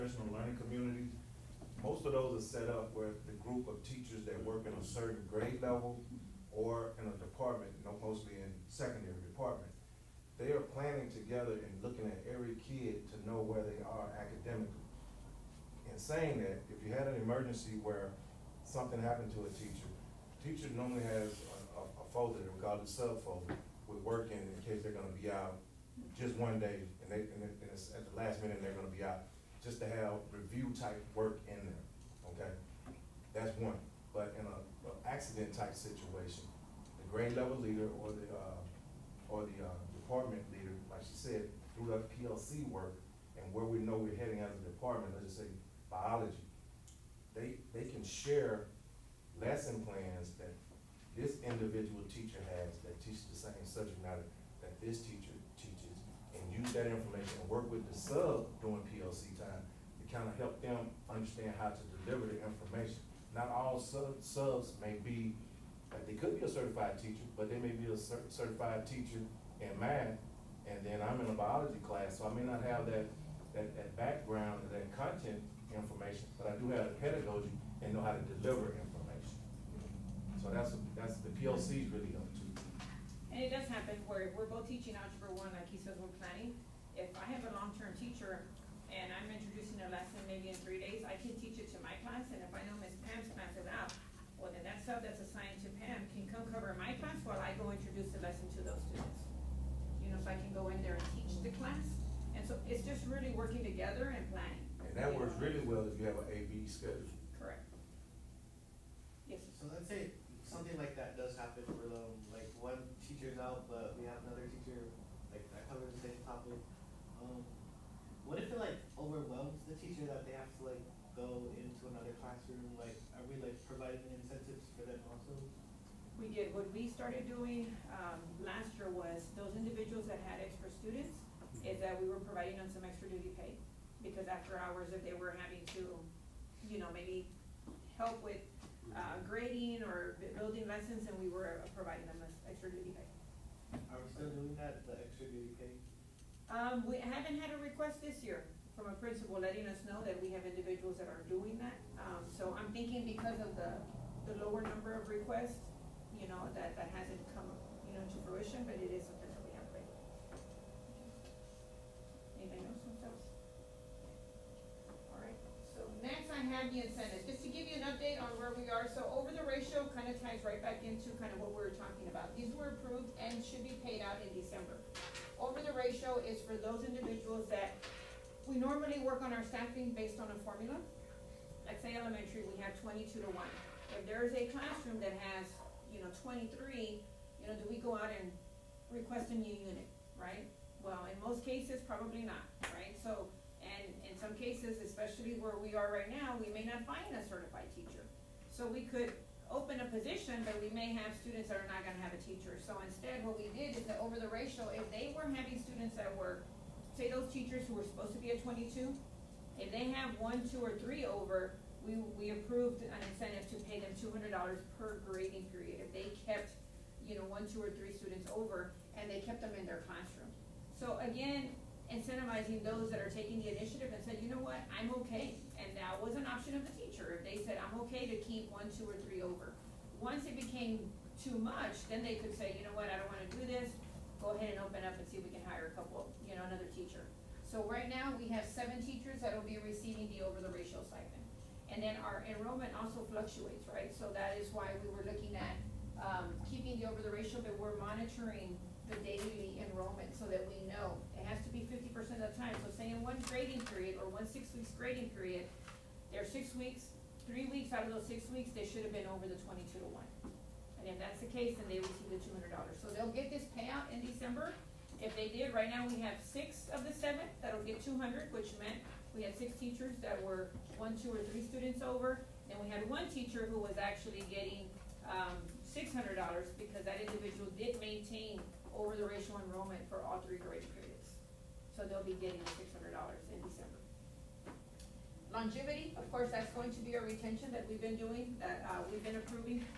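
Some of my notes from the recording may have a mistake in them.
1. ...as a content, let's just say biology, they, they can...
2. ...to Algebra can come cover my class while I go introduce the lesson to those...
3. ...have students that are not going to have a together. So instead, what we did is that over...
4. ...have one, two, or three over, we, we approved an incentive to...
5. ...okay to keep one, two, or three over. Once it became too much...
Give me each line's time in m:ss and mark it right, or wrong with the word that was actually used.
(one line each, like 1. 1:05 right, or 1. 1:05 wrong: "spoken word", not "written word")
1. 0:44 wrong: "department", not "content"
2. 1:35 wrong: "Pam", not "Algebra"
3. 3:20 wrong: "teacher", not "together"
4. 3:29 right
5. 3:47 right.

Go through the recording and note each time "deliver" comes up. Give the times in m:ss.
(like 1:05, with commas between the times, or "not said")
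1:02, 1:18.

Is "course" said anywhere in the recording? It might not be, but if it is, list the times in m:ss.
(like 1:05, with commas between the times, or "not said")
4:46.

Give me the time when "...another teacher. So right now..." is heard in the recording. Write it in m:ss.
3:56.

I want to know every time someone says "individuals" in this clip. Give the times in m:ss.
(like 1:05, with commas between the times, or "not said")
0:51, 2:09, 2:30, 2:56, 4:36.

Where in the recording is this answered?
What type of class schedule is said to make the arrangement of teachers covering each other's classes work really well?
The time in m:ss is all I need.
1:46.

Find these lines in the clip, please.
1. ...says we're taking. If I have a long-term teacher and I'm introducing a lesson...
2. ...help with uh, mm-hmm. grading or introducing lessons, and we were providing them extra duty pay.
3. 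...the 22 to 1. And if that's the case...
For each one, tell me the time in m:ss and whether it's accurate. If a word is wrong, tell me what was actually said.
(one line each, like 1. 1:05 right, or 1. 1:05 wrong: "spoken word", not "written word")
1. 1:25 wrong: "planning", not "taking"
2. 2:17 wrong: "building", not "introducing"
3. 4:19 right.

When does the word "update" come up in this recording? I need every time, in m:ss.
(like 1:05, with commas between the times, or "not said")
2:47.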